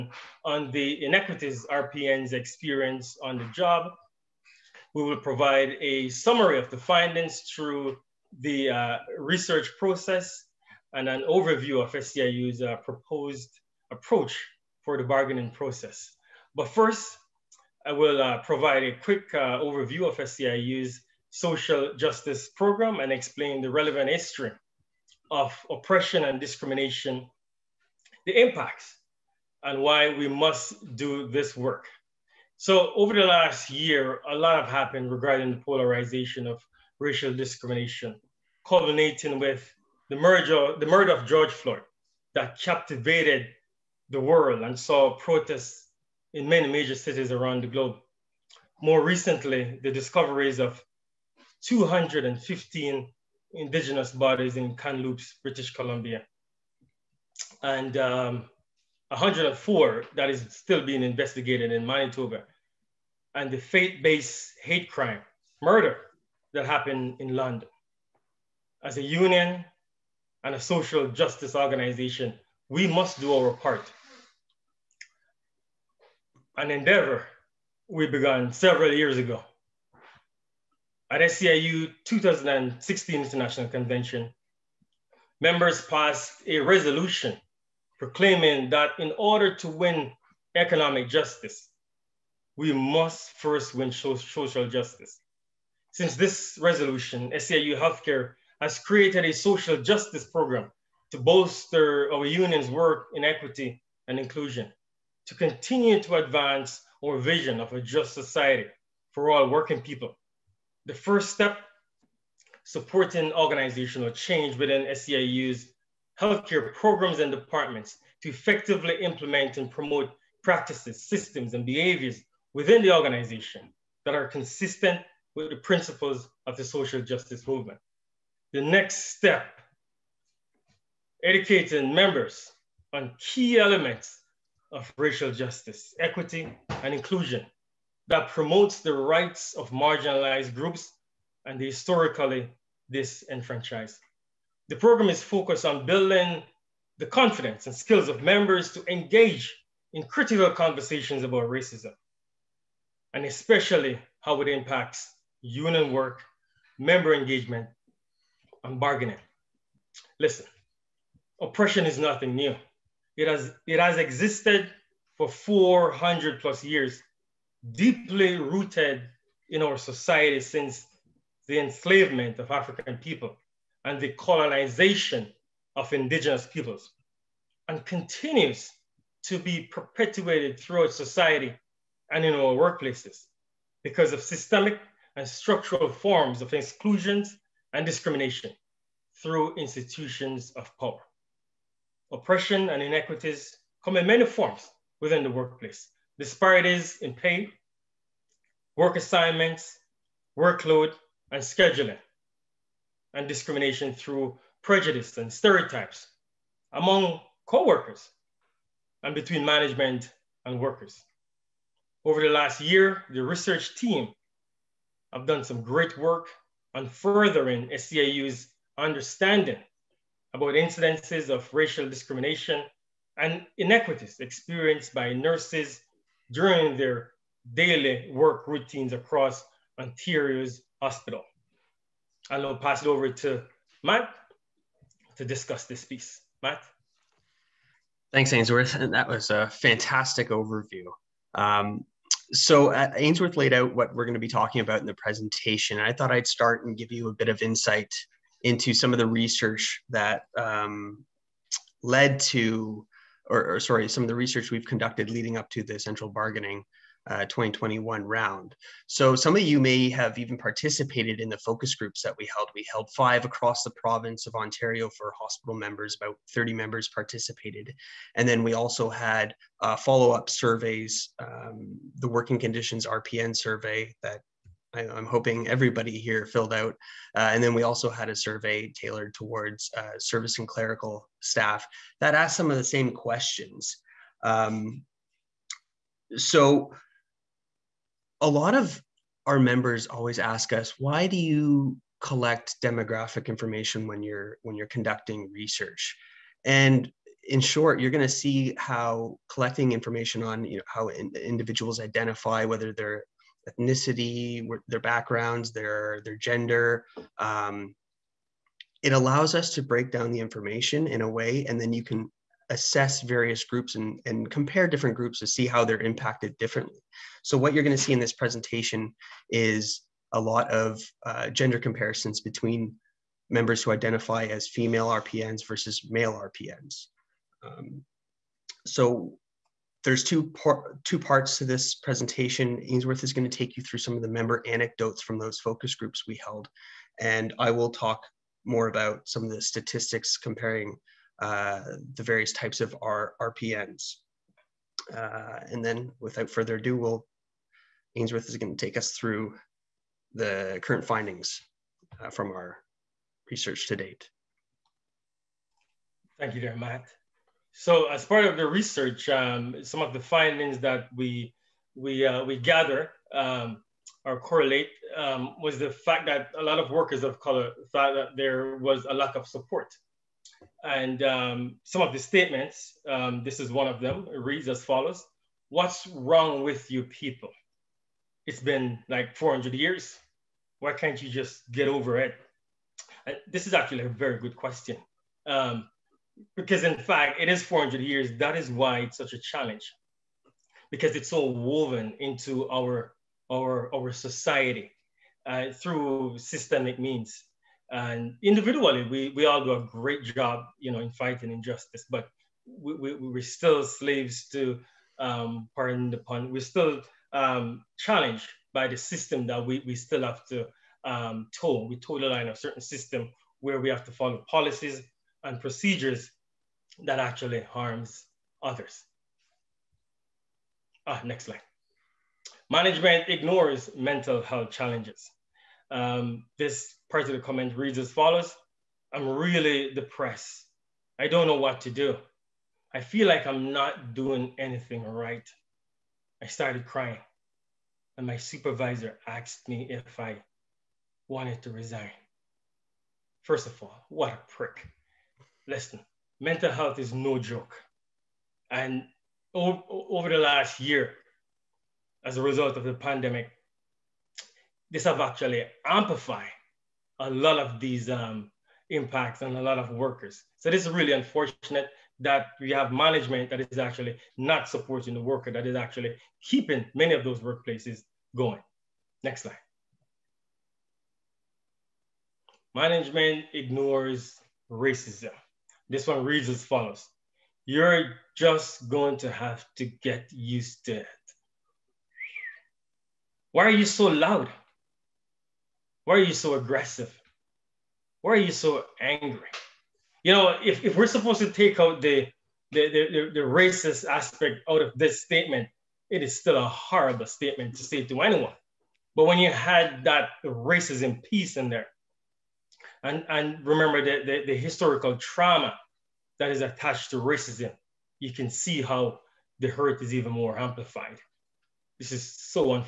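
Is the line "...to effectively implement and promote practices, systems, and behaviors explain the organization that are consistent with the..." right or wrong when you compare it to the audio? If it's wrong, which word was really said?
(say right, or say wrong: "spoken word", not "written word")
wrong: "within", not "explain".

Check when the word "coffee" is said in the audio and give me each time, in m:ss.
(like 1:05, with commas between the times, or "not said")
not said.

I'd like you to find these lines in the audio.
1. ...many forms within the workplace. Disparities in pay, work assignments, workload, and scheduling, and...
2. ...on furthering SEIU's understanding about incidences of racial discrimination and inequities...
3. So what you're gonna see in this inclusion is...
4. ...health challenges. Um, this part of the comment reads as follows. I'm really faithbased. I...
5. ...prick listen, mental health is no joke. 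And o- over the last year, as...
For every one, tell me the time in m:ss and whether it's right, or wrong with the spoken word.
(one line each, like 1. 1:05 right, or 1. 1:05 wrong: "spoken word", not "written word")
1. 3:14 right
2. 3:36 right
3. 5:17 wrong: "presentation", not "inclusion"
4. 7:04 wrong: "depressed", not "faithbased"
5. 7:24 right.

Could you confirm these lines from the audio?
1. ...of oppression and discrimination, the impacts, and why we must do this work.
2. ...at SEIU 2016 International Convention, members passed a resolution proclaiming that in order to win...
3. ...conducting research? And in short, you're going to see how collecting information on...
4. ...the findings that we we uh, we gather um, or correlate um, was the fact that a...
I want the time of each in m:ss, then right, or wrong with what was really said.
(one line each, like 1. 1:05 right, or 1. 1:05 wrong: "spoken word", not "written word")
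1. 0:25 right
2. 1:21 right
3. 4:54 right
4. 5:59 right.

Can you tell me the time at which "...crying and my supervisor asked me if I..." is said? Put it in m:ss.
7:16.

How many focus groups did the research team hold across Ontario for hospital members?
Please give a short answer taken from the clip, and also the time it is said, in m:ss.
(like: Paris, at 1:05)
five, at 4:22.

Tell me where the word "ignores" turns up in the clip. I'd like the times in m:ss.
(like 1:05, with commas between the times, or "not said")
7:03, 7:53.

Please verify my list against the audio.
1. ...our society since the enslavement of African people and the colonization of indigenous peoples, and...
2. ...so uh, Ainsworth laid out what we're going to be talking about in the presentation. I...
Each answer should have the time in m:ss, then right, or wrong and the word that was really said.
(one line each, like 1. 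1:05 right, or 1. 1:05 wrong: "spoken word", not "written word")
1. 2:49 right
2. 4:02 right.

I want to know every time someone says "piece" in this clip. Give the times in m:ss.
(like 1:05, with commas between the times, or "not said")
3:55, 8:21.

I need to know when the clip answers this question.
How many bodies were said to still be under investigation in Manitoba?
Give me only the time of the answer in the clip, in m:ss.
0:59.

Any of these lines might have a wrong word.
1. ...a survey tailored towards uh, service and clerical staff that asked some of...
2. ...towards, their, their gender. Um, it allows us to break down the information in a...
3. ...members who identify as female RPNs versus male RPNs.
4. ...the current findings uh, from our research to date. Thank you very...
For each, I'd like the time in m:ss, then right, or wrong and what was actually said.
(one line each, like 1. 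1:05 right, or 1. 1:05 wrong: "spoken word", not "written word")
1. 4:38 right
2. 5:04 wrong: "backgrounds", not "towards"
3. 5:23 right
4. 5:50 right.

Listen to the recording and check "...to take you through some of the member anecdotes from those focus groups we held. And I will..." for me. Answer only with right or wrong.
right.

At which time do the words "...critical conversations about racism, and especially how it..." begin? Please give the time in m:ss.
2:30.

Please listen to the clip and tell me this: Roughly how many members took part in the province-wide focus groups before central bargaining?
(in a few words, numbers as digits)
30.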